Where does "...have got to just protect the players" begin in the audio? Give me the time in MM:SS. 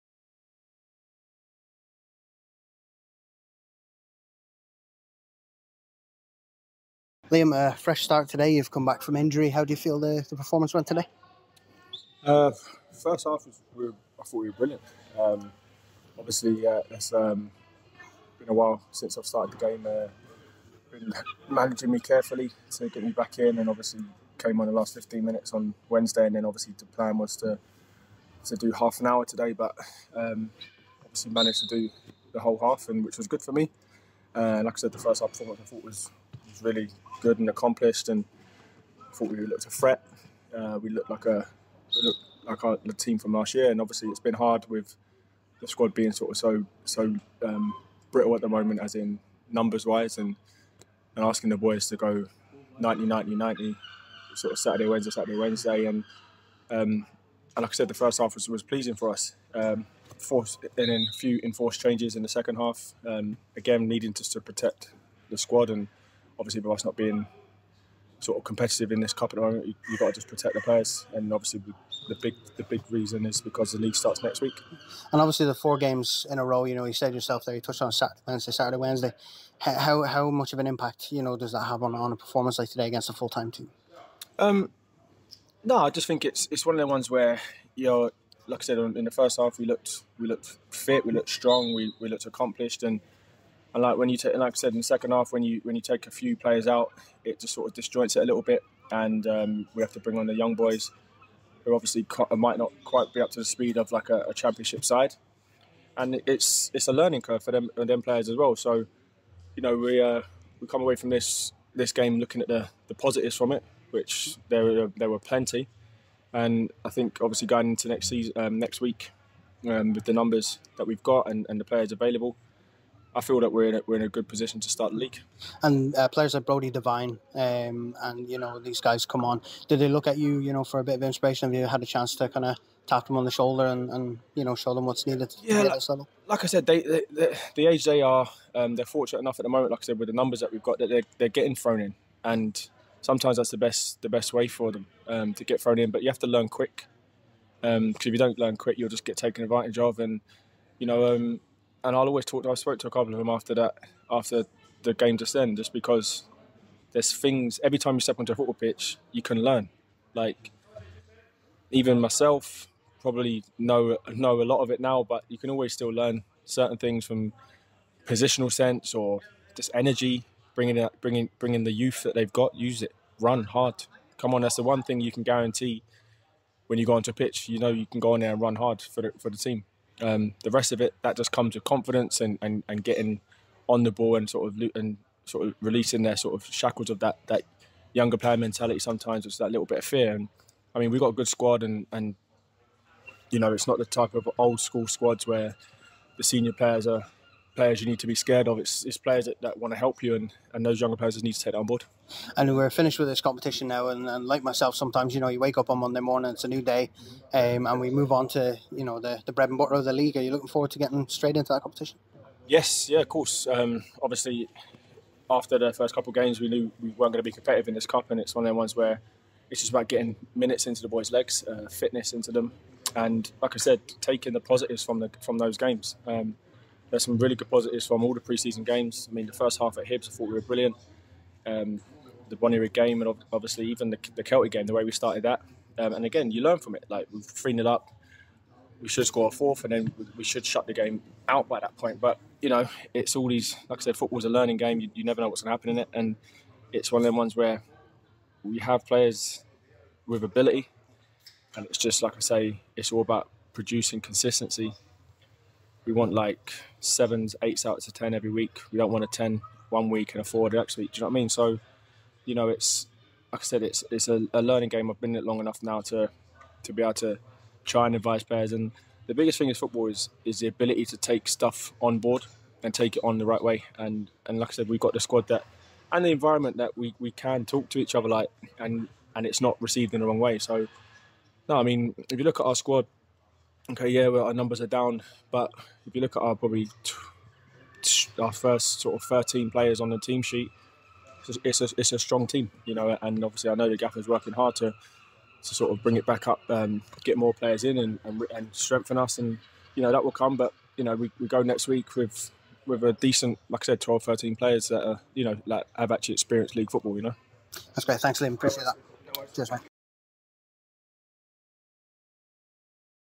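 01:09.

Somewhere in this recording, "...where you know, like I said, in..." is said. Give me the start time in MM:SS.
01:27.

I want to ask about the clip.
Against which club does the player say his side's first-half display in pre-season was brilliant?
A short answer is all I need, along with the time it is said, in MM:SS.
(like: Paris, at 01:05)
Hibs, at 03:49.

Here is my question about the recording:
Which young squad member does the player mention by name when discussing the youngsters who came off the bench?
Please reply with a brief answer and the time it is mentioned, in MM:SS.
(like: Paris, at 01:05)
Brody Devine, at 02:06.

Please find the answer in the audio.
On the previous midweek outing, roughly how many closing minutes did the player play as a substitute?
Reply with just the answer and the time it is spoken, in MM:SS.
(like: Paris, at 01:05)
15 minutes, at 00:24.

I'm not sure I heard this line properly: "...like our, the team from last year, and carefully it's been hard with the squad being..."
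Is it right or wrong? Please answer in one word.
wrong.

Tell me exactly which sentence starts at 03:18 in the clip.
It's, it's players that, that want to help you, and, and those younger players need to take that on board.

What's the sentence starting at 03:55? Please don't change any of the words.
Um, and again, you learn from it.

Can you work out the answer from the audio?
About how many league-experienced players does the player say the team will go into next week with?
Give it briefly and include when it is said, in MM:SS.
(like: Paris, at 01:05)
12 or 13, at 05:03.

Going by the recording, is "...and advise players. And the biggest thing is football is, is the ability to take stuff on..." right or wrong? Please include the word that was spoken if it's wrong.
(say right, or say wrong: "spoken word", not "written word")
right.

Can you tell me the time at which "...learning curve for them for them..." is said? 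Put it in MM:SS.
01:46.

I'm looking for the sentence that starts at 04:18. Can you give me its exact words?
We don't want a 10 one week and a four the next week.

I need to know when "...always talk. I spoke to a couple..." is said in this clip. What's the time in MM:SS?
02:32.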